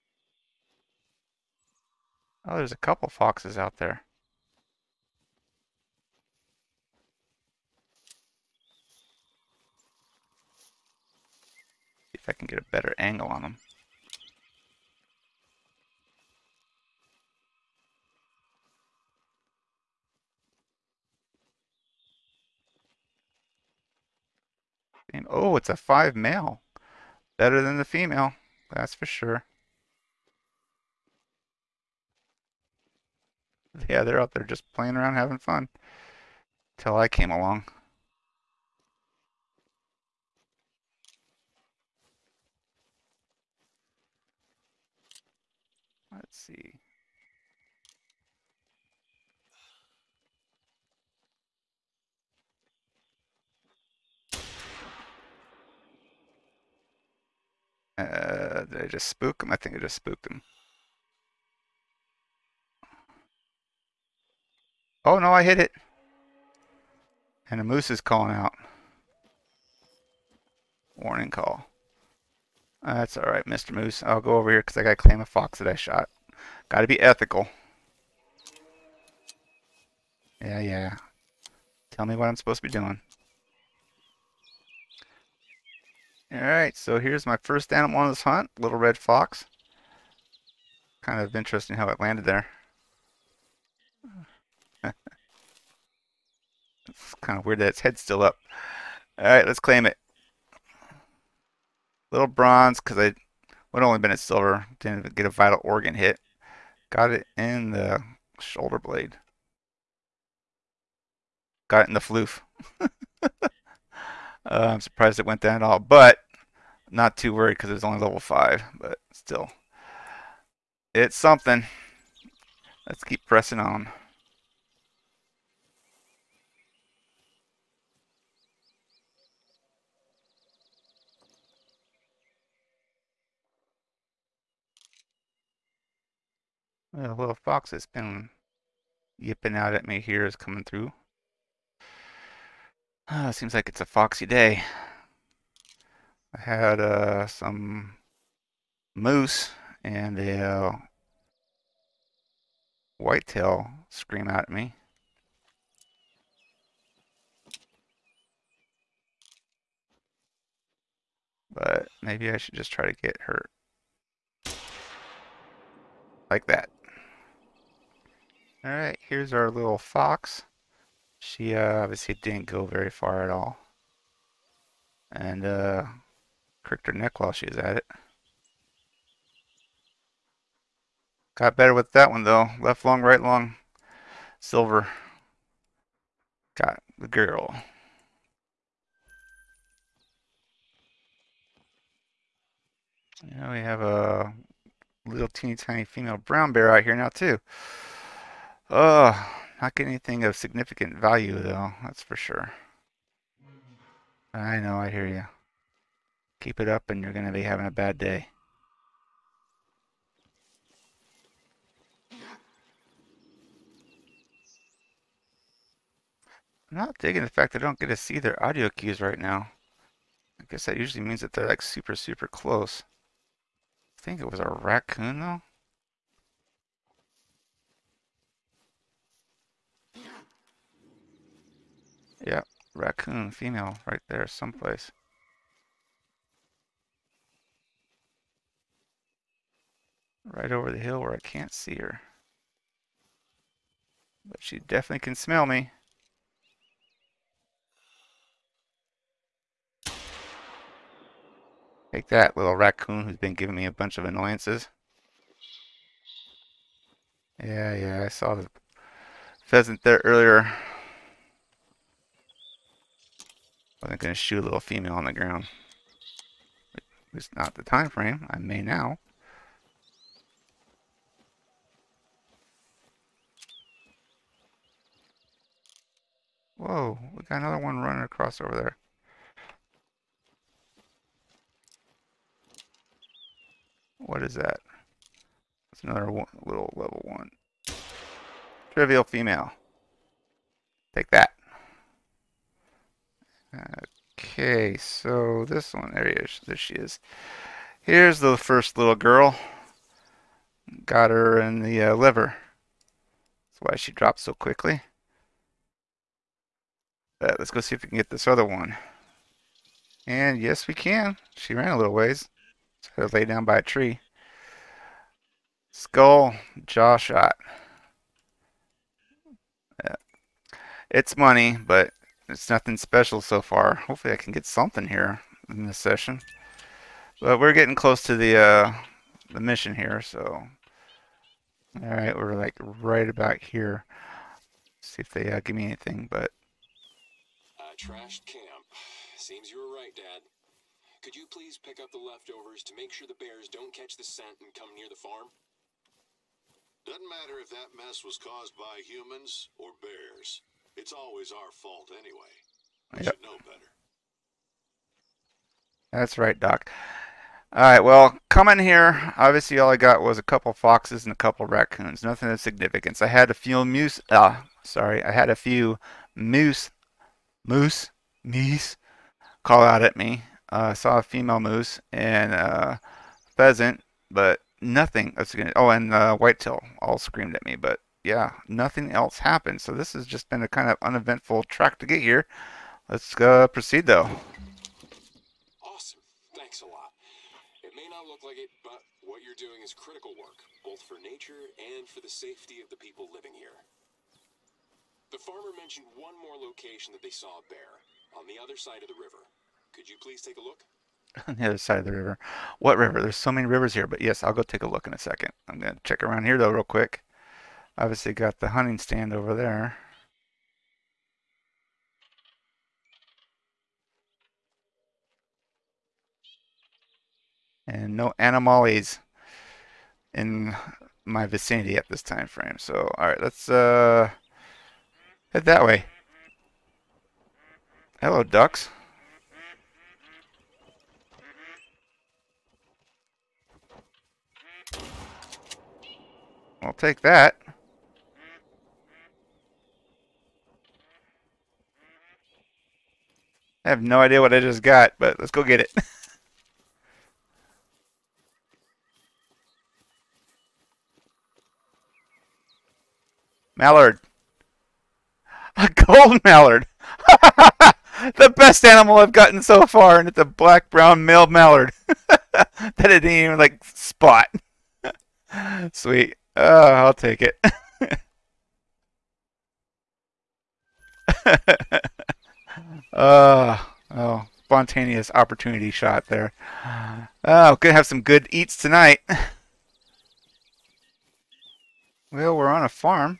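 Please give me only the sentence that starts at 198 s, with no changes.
Ugh, not getting anything of significant value though, that's for sure.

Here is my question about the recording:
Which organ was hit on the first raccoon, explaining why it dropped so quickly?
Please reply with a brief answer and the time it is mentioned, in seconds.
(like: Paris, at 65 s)
liver, at 301 s.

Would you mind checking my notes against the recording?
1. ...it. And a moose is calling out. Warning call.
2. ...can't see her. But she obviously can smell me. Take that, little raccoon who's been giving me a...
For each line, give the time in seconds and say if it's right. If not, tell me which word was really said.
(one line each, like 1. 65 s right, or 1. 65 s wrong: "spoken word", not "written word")
1. 65 s right
2. 241 s wrong: "definitely", not "obviously".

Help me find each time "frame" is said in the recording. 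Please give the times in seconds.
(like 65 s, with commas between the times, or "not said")
267 s, 422 s.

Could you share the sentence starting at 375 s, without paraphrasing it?
oh, and uh, whitetail all screamed at me, but yeah, nothing else happened.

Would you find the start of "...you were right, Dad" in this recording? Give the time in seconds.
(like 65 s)
339 s.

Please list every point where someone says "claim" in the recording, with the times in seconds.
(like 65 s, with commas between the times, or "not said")
74 s, 99 s.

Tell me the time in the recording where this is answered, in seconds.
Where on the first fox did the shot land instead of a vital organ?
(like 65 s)
108 s.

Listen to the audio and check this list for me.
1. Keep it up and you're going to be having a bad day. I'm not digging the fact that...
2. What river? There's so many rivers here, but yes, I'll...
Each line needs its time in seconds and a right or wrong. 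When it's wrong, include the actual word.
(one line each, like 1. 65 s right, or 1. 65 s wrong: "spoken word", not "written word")
1. 206 s right
2. 402 s right.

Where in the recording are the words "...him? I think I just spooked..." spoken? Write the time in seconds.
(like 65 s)
59 s.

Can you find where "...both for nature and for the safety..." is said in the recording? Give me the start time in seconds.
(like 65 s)
390 s.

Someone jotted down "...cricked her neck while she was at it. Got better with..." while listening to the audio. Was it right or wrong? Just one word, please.
right.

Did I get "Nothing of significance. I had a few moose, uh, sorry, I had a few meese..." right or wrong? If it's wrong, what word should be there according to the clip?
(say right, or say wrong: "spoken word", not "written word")
wrong: "moose", not "meese".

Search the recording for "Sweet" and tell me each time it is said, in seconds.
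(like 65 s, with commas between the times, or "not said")
465 s.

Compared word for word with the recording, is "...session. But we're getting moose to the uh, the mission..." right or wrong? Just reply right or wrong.
wrong.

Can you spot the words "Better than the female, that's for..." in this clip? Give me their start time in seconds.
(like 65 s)
27 s.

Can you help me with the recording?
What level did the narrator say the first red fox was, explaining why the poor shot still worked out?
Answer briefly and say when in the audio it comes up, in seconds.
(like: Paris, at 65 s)
5, at 118 s.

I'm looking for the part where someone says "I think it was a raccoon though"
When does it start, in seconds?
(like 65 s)
223 s.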